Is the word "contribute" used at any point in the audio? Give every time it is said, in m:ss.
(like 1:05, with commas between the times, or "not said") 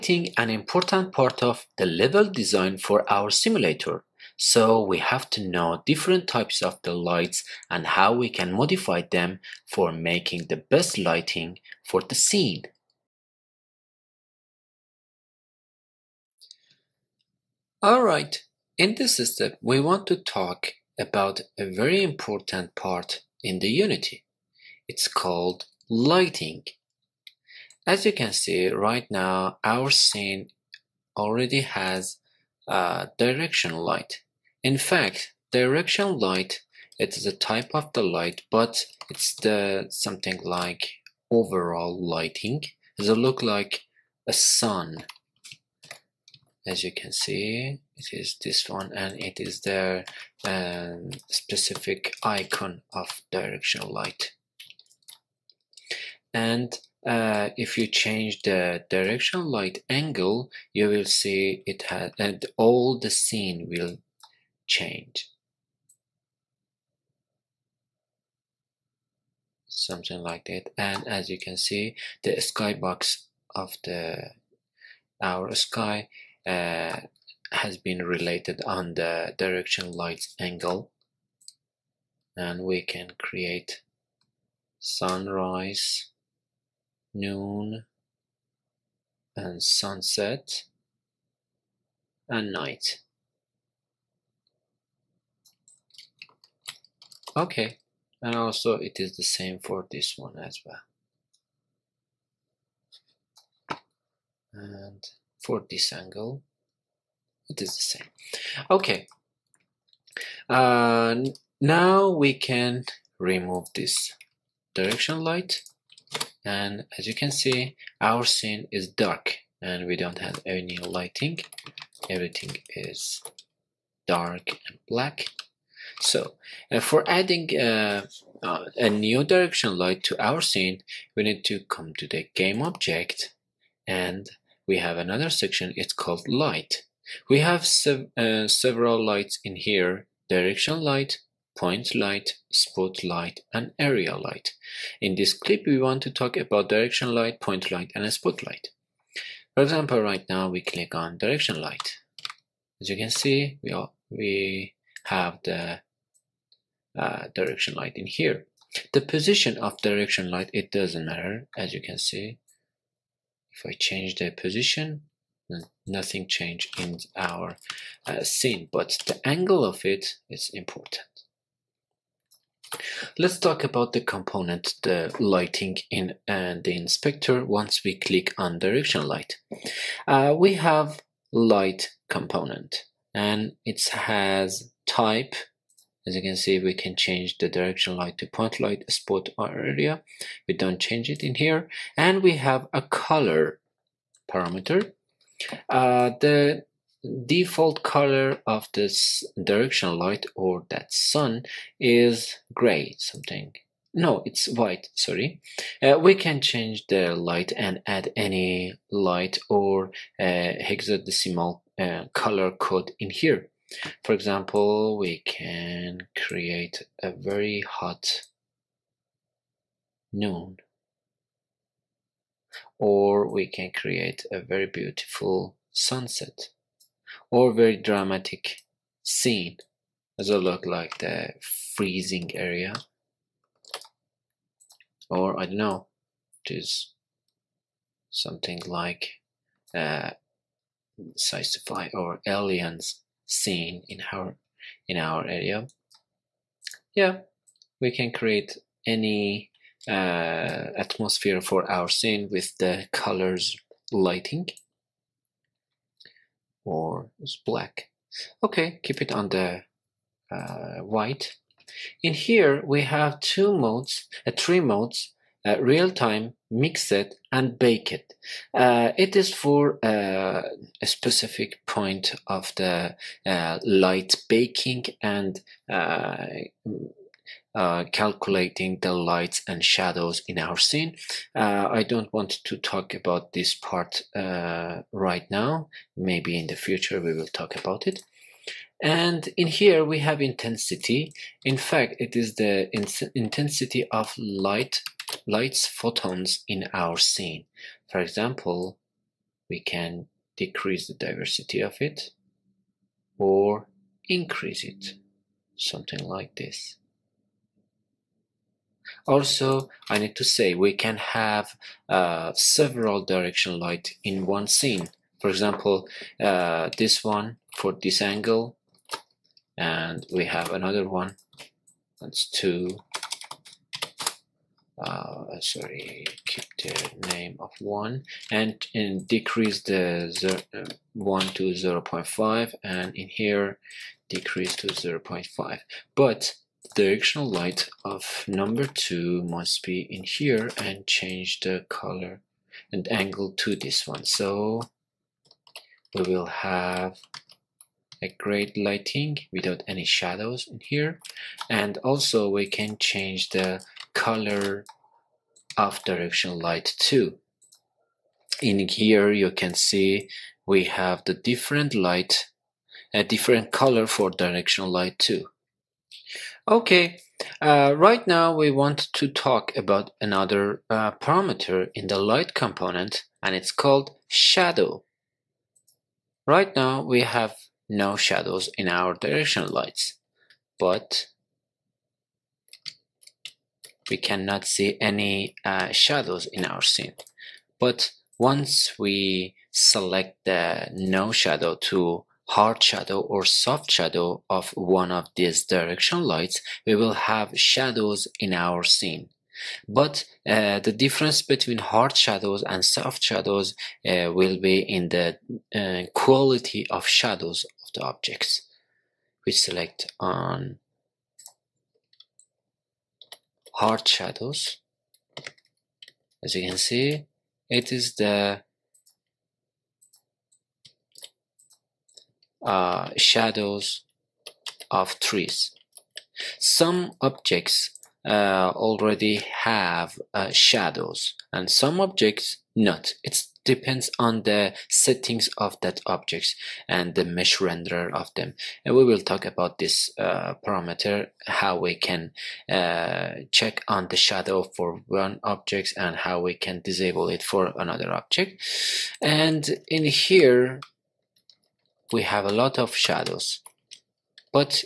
not said.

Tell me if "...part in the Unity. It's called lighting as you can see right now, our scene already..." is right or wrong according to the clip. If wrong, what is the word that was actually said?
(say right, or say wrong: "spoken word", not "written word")
right.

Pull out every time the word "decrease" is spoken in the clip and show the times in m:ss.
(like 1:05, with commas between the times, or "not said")
5:00, 5:29, 5:34.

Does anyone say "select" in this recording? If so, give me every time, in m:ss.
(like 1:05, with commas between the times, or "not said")
6:29, 6:49.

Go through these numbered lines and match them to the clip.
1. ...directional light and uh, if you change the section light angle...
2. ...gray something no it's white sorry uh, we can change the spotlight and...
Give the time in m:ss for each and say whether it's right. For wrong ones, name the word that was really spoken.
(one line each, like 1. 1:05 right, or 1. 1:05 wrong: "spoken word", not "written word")
1. 0:53 wrong: "direction", not "section"
2. 3:22 wrong: "light", not "spotlight".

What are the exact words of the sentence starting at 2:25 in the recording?
In this clip, we want to talk about direction light, point light, and spotlight.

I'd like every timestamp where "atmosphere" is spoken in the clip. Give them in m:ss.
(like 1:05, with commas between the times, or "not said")
4:10.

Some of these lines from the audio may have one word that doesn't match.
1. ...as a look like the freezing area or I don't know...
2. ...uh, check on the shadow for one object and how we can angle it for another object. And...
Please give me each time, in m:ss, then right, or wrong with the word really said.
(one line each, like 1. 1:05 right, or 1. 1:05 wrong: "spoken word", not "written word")
1. 3:50 right
2. 7:22 wrong: "disable", not "angle".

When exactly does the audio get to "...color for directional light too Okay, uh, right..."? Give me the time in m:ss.
6:03.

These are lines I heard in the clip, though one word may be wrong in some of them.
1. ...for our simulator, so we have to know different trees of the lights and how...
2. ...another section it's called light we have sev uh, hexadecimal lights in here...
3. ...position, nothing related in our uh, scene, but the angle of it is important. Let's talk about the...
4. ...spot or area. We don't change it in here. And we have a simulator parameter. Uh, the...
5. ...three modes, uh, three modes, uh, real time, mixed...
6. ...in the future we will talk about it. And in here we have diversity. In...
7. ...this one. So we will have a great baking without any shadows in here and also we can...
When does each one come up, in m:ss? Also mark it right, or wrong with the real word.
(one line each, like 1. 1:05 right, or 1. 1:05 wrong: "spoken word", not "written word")
1. 0:02 wrong: "types", not "trees"
2. 2:14 wrong: "several", not "hexadecimal"
3. 2:44 wrong: "changed", not "related"
4. 3:08 wrong: "color", not "simulator"
5. 4:23 wrong: "two", not "three"
6. 4:46 wrong: "intensity", not "diversity"
7. 5:43 wrong: "lighting", not "baking".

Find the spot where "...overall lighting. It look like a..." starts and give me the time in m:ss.
0:41.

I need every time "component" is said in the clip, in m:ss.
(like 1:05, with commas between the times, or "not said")
2:53, 3:02, 6:12.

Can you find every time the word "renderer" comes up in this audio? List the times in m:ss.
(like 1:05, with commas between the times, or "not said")
7:17.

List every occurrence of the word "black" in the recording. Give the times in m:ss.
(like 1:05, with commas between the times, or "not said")
2:04, 4:17.